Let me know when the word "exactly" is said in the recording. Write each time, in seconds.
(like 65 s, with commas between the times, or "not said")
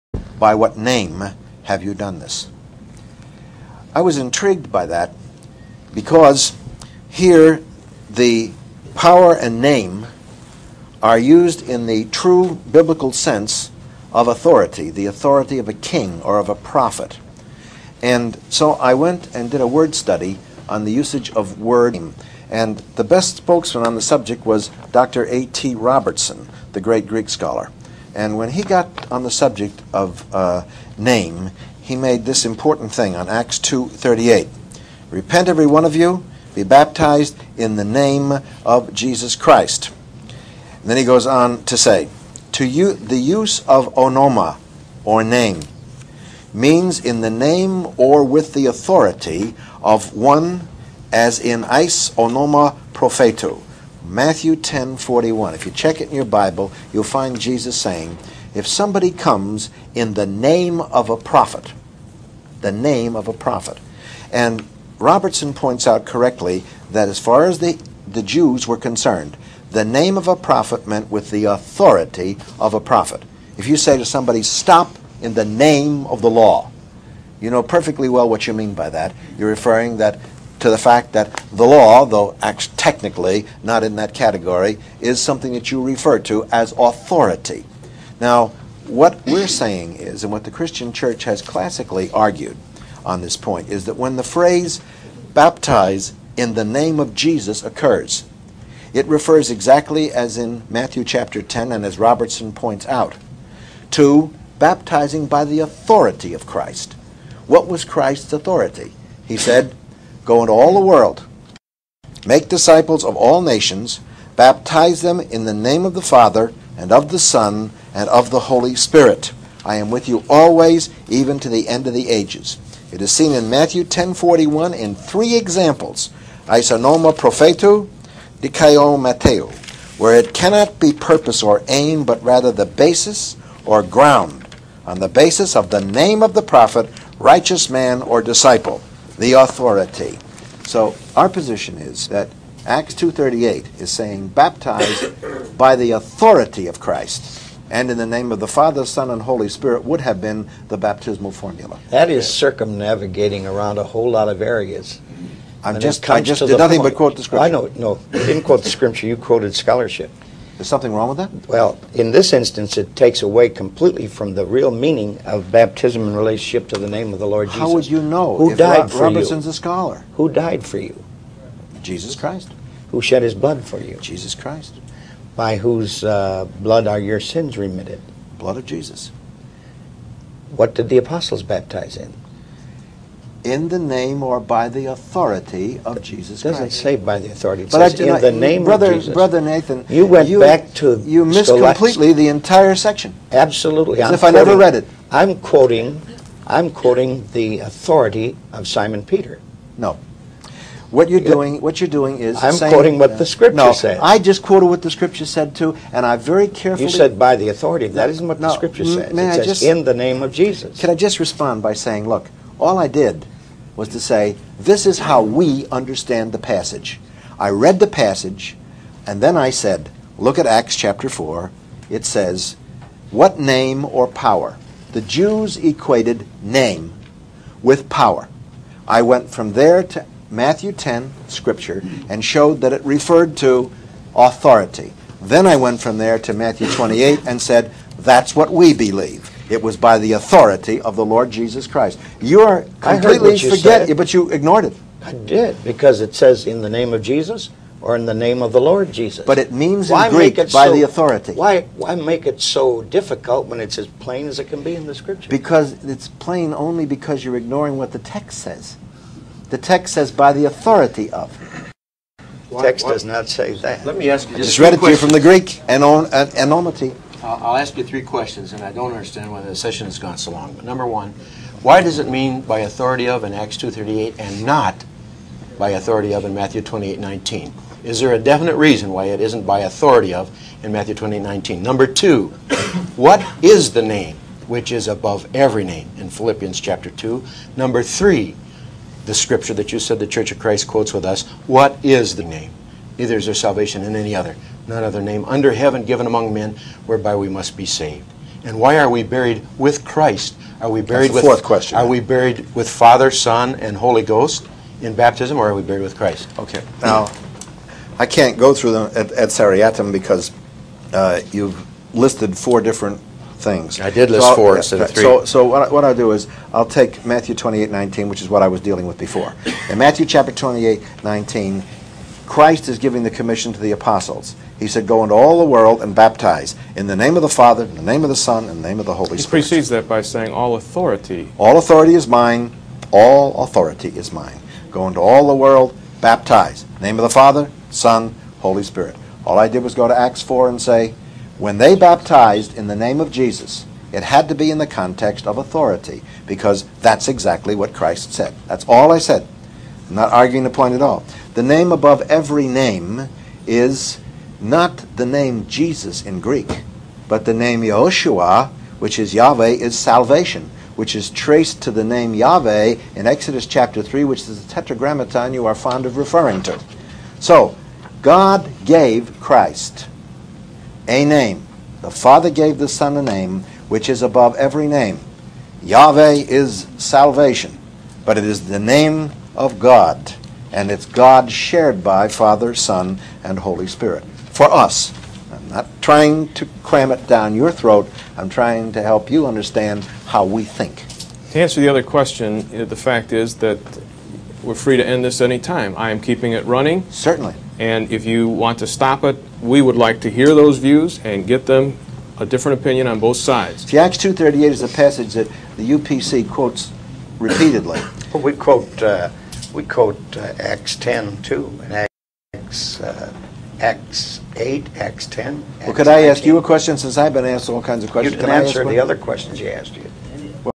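99 s, 347 s.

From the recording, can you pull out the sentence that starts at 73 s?
If you say to somebody, stop in the name of the law, you know perfectly well what you mean by that.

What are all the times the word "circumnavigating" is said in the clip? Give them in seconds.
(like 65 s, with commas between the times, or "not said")
152 s.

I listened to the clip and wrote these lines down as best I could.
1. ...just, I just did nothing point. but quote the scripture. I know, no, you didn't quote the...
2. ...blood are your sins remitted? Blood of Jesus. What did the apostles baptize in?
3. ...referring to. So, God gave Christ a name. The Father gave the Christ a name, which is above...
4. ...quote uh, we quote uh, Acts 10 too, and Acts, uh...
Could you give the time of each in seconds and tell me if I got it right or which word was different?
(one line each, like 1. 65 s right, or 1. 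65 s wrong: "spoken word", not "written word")
1. 155 s right
2. 176 s right
3. 365 s wrong: "Son", not "Christ"
4. 408 s right.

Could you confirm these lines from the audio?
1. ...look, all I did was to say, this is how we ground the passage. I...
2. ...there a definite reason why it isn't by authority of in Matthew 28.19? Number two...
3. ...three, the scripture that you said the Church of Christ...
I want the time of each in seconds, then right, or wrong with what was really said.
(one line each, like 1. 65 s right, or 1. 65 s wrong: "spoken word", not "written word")
1. 212 s wrong: "understand", not "ground"
2. 277 s right
3. 287 s right.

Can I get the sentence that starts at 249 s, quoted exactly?
But it means why in Greek by so, the authority.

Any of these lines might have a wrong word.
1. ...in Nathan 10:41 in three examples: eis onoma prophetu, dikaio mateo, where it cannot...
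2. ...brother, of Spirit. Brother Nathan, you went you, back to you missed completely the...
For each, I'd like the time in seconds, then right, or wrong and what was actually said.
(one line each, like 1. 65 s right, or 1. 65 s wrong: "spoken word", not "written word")
1. 123 s wrong: "Matthew", not "Nathan"
2. 188 s wrong: "Jesus", not "Spirit".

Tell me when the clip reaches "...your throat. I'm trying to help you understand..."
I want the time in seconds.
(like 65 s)
387 s.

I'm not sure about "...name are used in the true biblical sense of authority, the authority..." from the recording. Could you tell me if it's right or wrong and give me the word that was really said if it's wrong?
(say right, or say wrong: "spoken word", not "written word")
right.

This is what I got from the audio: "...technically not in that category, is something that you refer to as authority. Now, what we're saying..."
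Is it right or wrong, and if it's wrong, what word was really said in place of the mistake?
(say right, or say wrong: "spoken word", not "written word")
right.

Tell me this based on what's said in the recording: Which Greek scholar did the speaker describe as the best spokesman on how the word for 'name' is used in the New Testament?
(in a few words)
A.T. Robertson.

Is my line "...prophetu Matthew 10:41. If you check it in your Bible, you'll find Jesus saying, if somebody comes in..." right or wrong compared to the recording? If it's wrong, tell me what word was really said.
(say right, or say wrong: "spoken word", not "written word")
right.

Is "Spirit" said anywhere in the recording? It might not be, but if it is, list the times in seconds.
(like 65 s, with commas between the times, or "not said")
118 s, 149 s, 329 s, 338 s, 383 s.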